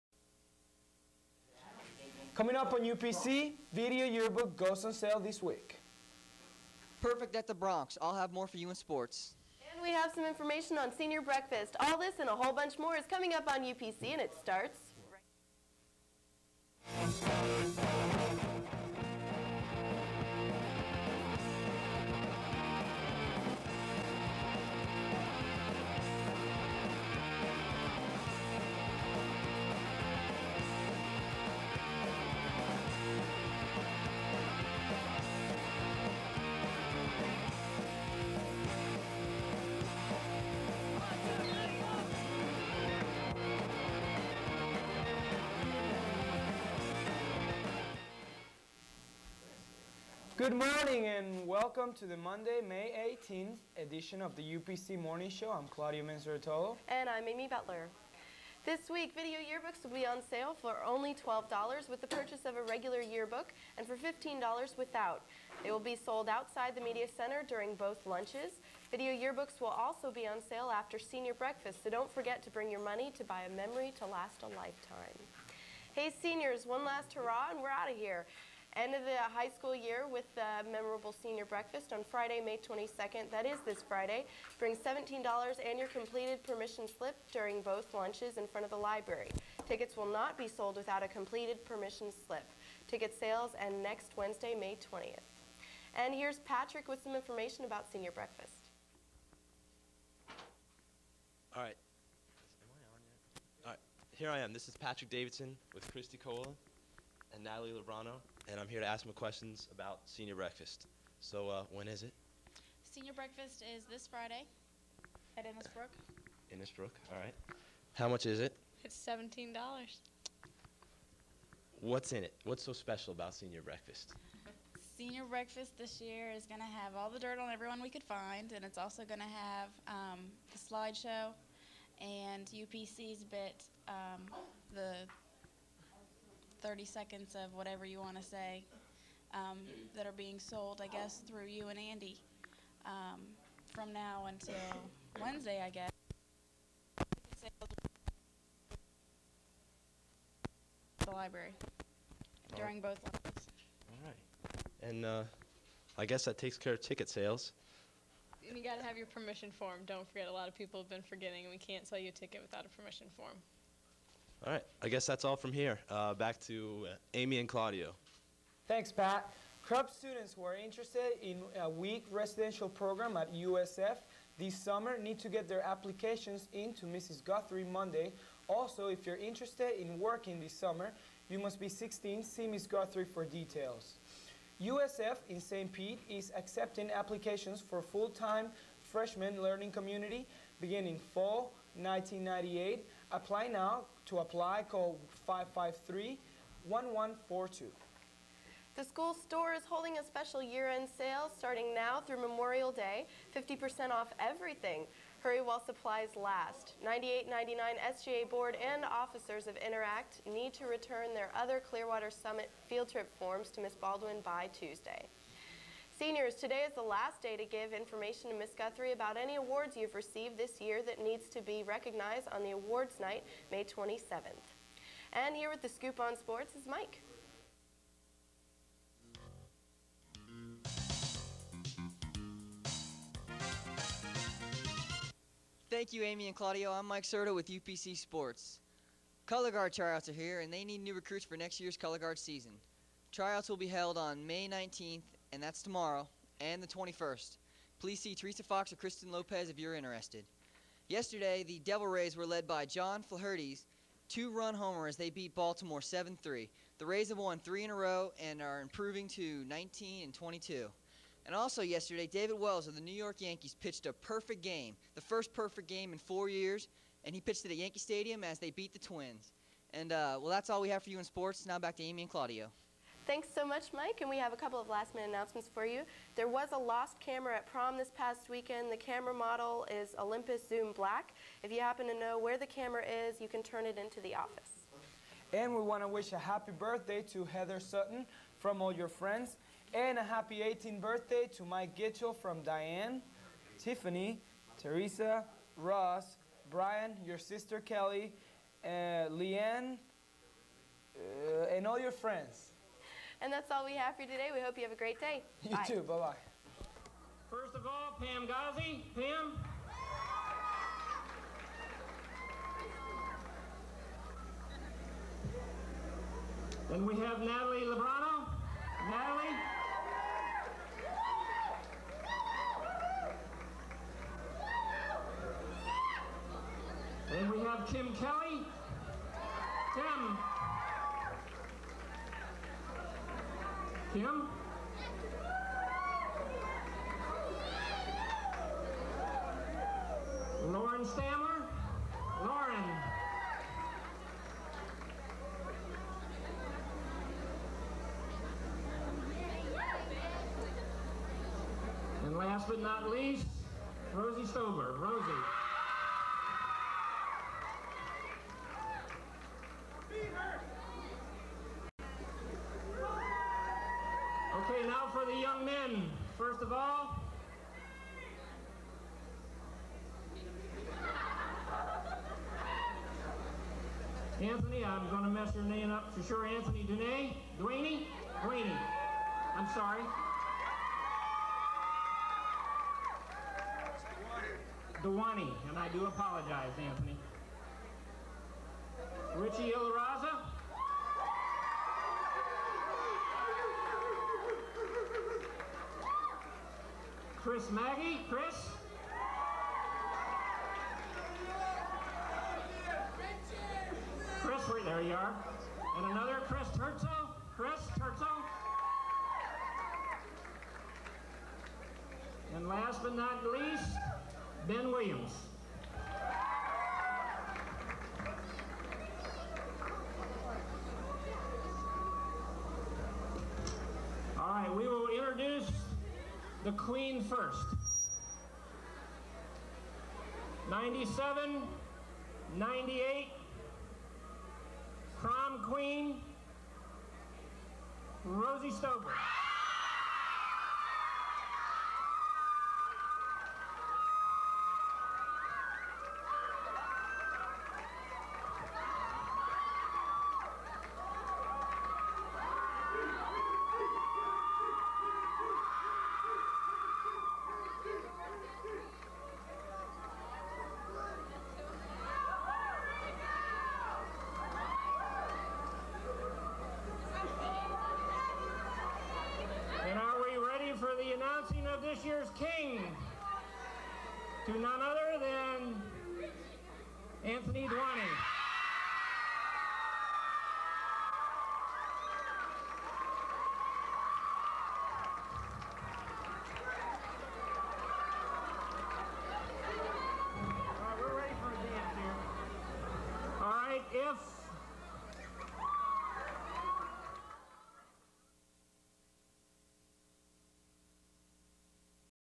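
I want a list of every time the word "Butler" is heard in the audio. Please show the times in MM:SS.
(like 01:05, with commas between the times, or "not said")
00:57.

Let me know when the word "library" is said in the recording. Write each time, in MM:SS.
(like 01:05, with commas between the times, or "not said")
01:28, 02:31.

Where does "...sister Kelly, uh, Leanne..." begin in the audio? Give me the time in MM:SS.
04:57.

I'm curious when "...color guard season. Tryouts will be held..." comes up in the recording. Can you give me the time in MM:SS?
04:01.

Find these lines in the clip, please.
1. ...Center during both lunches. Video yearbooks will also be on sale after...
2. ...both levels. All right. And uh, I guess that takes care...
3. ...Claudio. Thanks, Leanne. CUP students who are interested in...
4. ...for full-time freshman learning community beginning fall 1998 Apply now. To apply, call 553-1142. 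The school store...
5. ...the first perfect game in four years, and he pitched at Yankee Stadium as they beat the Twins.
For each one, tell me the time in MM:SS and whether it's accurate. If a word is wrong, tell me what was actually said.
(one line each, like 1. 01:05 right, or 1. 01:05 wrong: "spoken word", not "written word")
1. 01:07 right
2. 02:32 right
3. 02:47 wrong: "Pat", not "Leanne"
4. 03:07 right
5. 04:24 right.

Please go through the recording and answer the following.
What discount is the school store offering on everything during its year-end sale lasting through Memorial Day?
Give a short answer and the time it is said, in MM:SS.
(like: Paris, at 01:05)
50%, at 03:23.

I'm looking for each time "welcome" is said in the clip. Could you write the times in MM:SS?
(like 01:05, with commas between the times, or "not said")
00:51.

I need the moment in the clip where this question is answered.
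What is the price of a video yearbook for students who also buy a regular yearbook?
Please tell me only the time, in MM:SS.
01:00.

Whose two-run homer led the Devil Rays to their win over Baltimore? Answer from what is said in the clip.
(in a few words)
John Flaherty.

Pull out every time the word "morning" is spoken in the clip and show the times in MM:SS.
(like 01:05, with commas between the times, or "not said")
00:50, 00:54.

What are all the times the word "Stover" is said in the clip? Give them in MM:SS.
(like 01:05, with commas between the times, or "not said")
05:54, 07:18.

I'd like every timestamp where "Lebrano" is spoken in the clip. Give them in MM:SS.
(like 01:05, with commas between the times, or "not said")
01:47, 05:17.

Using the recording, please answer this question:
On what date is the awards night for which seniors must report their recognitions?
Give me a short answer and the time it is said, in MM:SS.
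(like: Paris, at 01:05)
May 27th, at 03:43.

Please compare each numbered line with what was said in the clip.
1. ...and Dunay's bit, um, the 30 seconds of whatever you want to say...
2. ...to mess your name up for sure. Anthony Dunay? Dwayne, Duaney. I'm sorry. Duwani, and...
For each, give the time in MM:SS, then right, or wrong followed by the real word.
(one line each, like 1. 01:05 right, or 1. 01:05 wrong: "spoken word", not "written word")
1. 02:12 wrong: "UPC", not "Dunay"
2. 06:15 right.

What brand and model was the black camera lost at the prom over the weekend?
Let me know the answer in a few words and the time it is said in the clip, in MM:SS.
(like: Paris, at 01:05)
Olympus Zoom, at 04:39.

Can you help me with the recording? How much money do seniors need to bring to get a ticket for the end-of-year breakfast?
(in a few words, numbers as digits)
$17.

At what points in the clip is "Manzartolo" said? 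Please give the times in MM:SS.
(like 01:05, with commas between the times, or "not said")
00:56.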